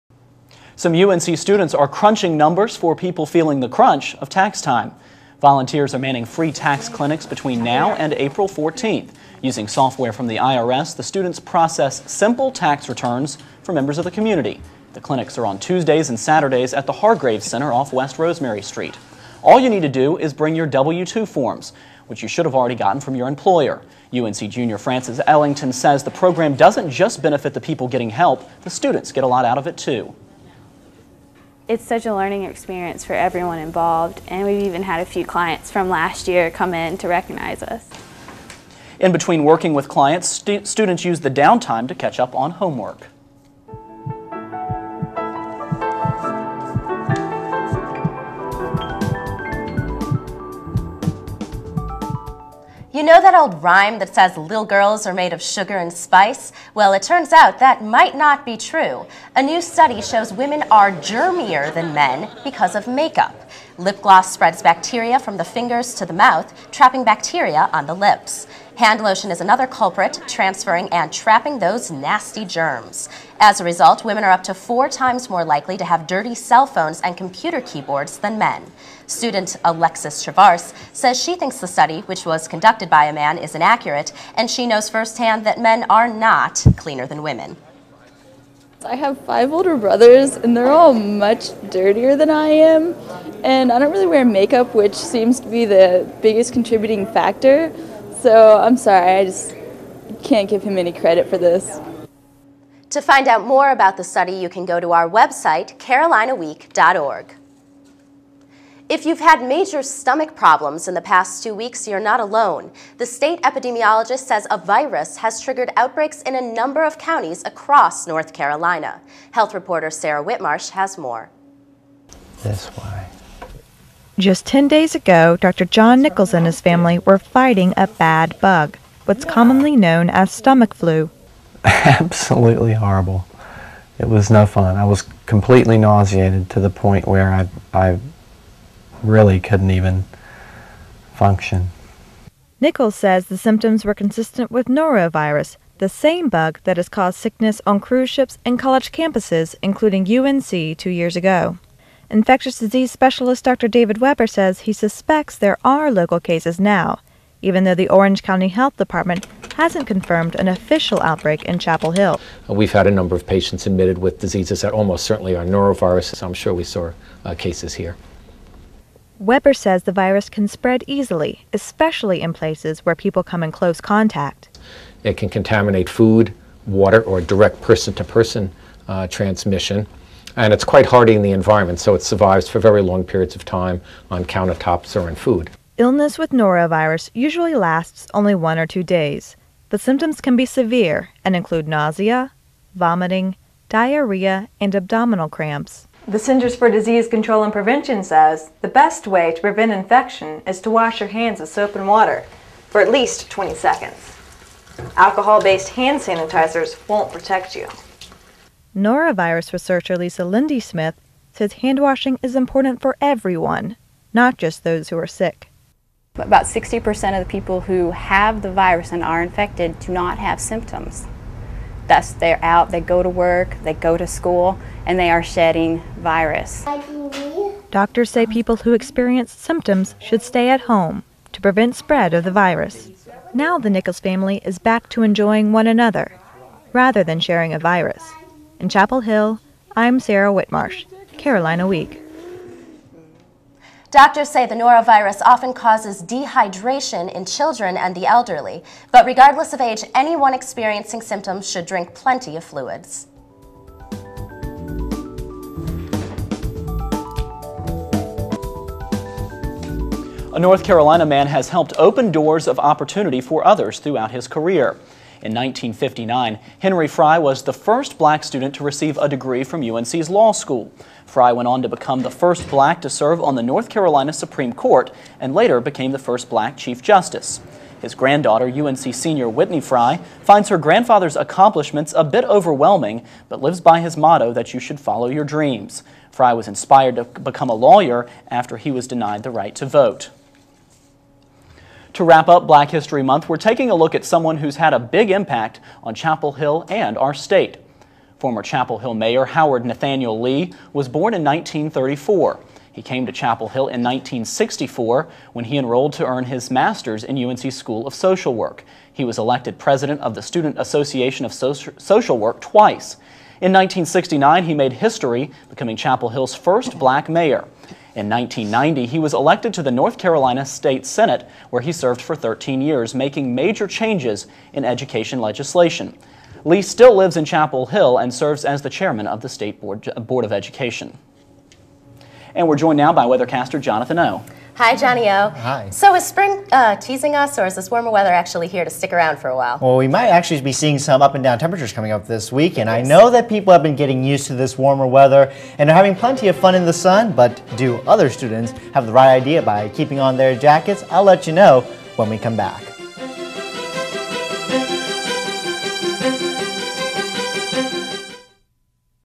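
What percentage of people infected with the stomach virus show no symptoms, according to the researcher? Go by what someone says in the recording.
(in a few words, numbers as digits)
60%.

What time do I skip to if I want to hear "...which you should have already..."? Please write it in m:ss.
0:22.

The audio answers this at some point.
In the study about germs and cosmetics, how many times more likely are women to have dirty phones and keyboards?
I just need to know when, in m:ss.
1:14.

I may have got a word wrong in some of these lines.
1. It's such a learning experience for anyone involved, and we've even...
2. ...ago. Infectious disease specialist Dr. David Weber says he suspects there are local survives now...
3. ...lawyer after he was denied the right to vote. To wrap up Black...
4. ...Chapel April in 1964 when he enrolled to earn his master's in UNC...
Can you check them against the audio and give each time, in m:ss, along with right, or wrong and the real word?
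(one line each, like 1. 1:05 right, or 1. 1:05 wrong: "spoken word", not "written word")
1. 0:31 wrong: "everyone", not "anyone"
2. 2:31 wrong: "cases", not "survives"
3. 4:47 right
4. 5:03 wrong: "Hill", not "April".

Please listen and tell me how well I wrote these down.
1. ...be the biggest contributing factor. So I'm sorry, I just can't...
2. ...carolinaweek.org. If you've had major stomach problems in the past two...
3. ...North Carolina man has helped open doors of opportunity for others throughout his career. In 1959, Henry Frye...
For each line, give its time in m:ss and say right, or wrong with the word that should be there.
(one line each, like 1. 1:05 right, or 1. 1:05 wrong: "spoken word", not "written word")
1. 1:35 right
2. 1:45 right
3. 4:20 right.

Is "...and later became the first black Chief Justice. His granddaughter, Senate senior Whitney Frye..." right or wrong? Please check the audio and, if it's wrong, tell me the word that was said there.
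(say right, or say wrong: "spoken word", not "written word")
wrong: "UNC", not "Senate".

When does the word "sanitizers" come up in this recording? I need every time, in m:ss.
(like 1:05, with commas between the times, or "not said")
3:26.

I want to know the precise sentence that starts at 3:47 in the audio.
Doctors say people who experience symptoms should stay at home to prevent spread of the virus.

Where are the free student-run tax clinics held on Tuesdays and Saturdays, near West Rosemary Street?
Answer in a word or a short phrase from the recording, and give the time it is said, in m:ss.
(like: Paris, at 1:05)
Hargrave Center, at 0:16.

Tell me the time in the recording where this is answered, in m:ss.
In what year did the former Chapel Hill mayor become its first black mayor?
5:13.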